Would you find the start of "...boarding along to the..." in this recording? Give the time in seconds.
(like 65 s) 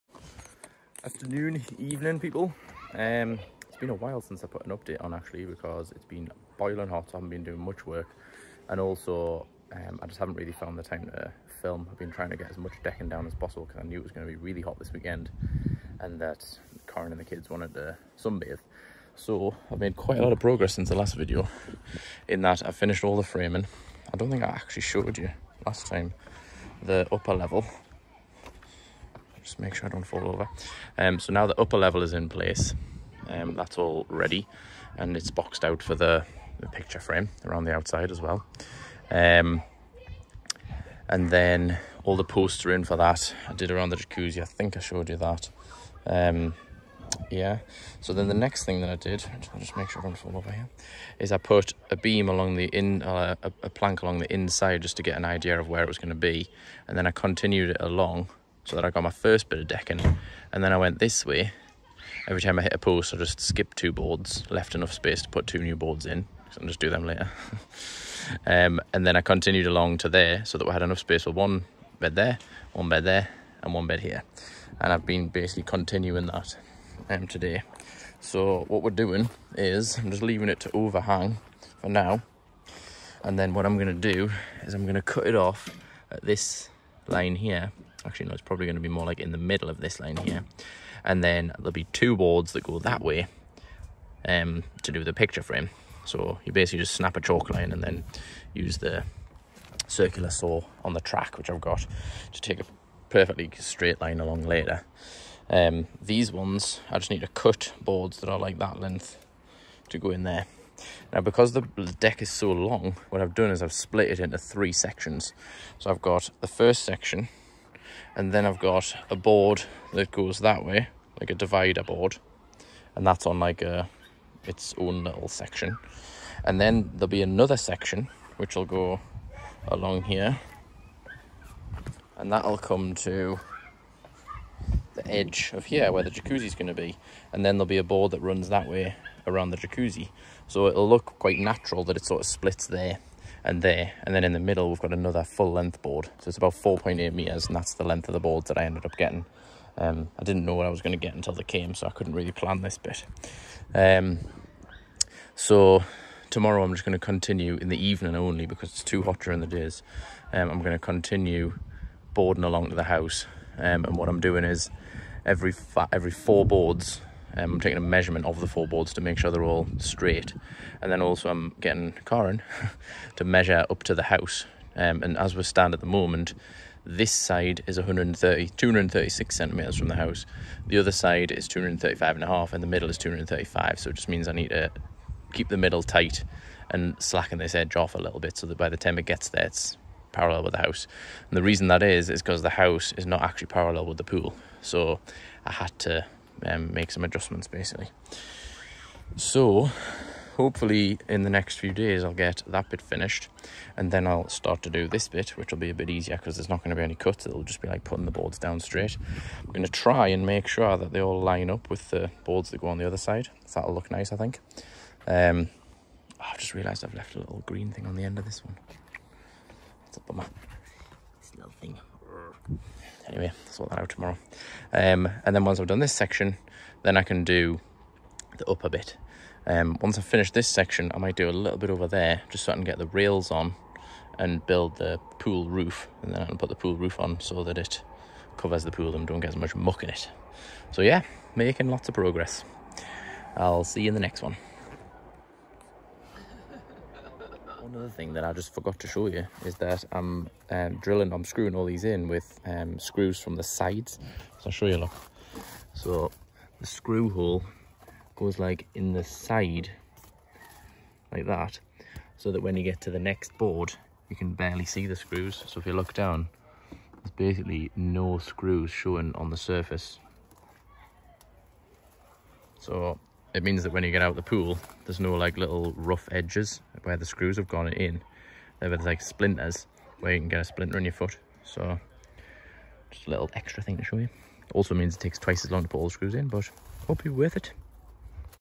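162 s.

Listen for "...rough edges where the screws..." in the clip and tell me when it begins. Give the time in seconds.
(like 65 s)
275 s.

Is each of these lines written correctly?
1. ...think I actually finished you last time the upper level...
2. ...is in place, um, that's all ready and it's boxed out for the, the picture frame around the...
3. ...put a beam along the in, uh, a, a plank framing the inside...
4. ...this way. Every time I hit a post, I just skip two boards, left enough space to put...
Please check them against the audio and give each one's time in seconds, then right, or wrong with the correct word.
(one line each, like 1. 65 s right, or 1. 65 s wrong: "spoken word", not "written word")
1. 24 s wrong: "showed", not "finished"
2. 32 s right
3. 51 s wrong: "along", not "framing"
4. 60 s right.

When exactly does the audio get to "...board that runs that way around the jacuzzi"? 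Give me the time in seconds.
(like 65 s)
137 s.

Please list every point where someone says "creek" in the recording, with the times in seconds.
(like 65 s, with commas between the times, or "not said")
not said.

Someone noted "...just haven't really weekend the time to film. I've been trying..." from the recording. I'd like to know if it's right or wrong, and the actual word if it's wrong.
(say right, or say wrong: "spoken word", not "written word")
wrong: "found", not "weekend".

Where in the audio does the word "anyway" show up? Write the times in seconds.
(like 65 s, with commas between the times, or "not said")
223 s.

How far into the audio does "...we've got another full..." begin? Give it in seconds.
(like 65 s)
144 s.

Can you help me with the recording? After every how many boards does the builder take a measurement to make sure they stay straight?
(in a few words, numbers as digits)
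4.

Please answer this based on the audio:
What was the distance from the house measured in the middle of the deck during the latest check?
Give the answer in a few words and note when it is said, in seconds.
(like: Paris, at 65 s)
235 centimeters, at 182 s.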